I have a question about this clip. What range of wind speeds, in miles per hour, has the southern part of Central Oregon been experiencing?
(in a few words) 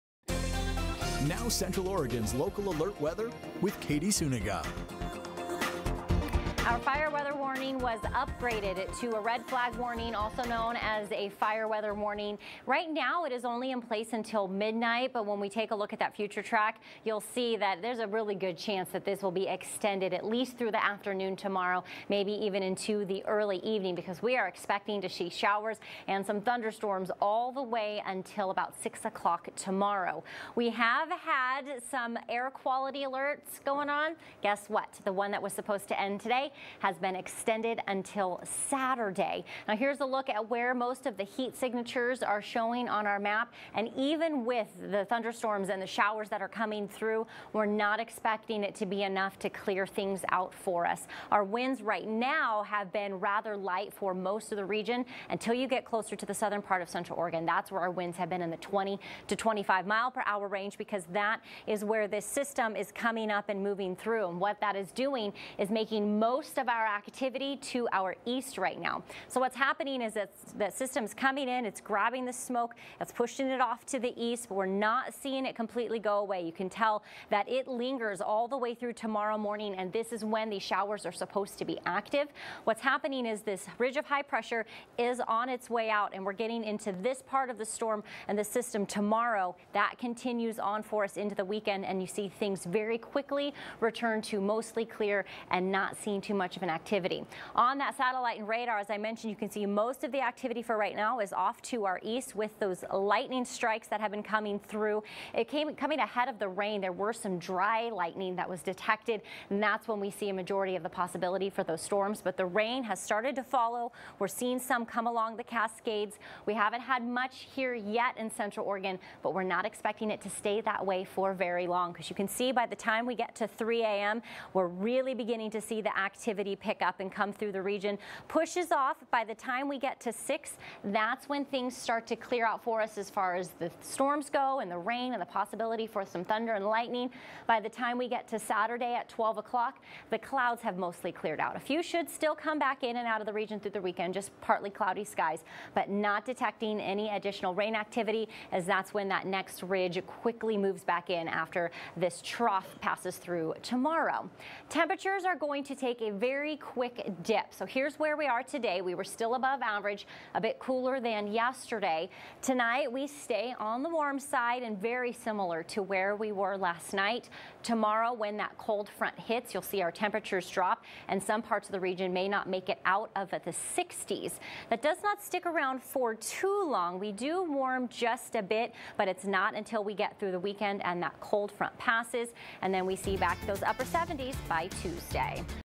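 20 to 25.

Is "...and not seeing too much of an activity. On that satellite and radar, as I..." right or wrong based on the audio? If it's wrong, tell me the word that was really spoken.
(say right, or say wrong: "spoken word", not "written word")
right.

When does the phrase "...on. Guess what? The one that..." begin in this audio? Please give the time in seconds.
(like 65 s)
33 s.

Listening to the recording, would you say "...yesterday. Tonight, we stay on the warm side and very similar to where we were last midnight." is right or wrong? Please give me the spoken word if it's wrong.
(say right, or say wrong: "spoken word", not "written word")
wrong: "night", not "midnight".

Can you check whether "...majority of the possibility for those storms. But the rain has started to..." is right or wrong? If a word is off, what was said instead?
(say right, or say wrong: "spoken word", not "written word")
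right.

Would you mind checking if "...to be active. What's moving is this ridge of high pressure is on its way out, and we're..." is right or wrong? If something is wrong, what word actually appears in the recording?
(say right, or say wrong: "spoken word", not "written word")
wrong: "happening", not "moving".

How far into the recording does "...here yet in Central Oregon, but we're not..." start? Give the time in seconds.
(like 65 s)
117 s.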